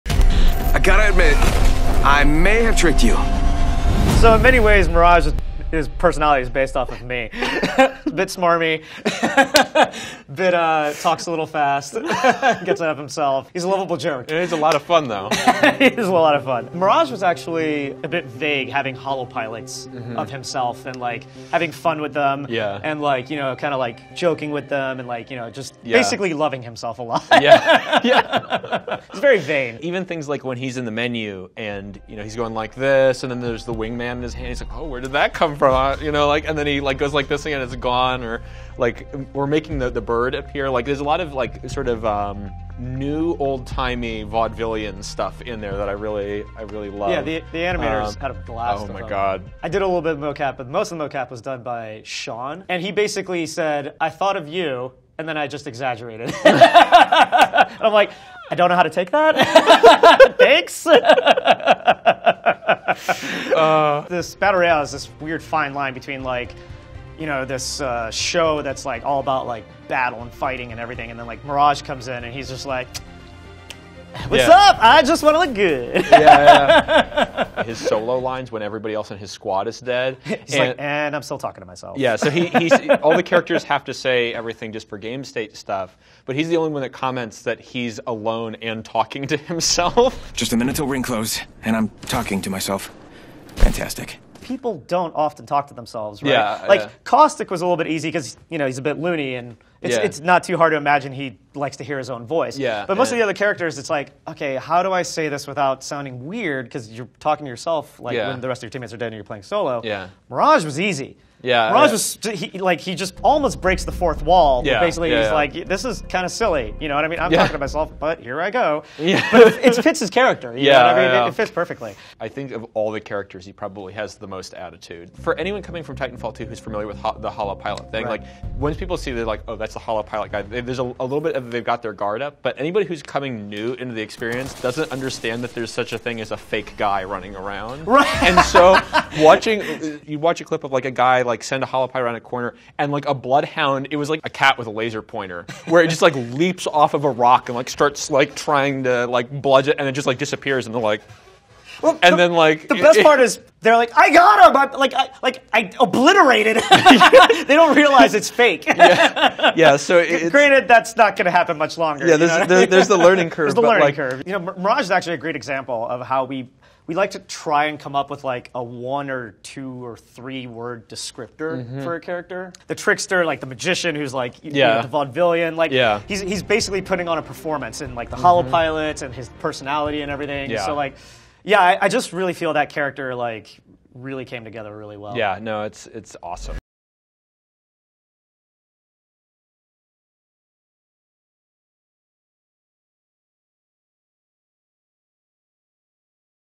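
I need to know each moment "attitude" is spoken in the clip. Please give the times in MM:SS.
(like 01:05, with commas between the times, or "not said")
02:04.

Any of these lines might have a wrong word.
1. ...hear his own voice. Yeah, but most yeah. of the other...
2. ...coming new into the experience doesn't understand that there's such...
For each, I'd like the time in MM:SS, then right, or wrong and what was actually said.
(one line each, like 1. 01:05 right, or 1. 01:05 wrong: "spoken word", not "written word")
1. 01:41 right
2. 02:13 right.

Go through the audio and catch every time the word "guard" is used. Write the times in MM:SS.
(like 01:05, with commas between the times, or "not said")
02:11.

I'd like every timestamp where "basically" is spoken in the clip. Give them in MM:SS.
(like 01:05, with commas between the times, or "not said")
00:25, 00:52, 01:54, 02:56.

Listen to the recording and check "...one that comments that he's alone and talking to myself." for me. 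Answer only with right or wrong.
wrong.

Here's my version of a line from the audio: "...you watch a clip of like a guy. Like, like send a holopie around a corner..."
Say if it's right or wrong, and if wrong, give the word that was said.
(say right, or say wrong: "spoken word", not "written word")
right.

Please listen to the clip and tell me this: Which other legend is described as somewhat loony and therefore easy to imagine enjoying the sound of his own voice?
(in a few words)
Caustic.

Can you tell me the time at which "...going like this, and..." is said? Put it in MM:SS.
00:32.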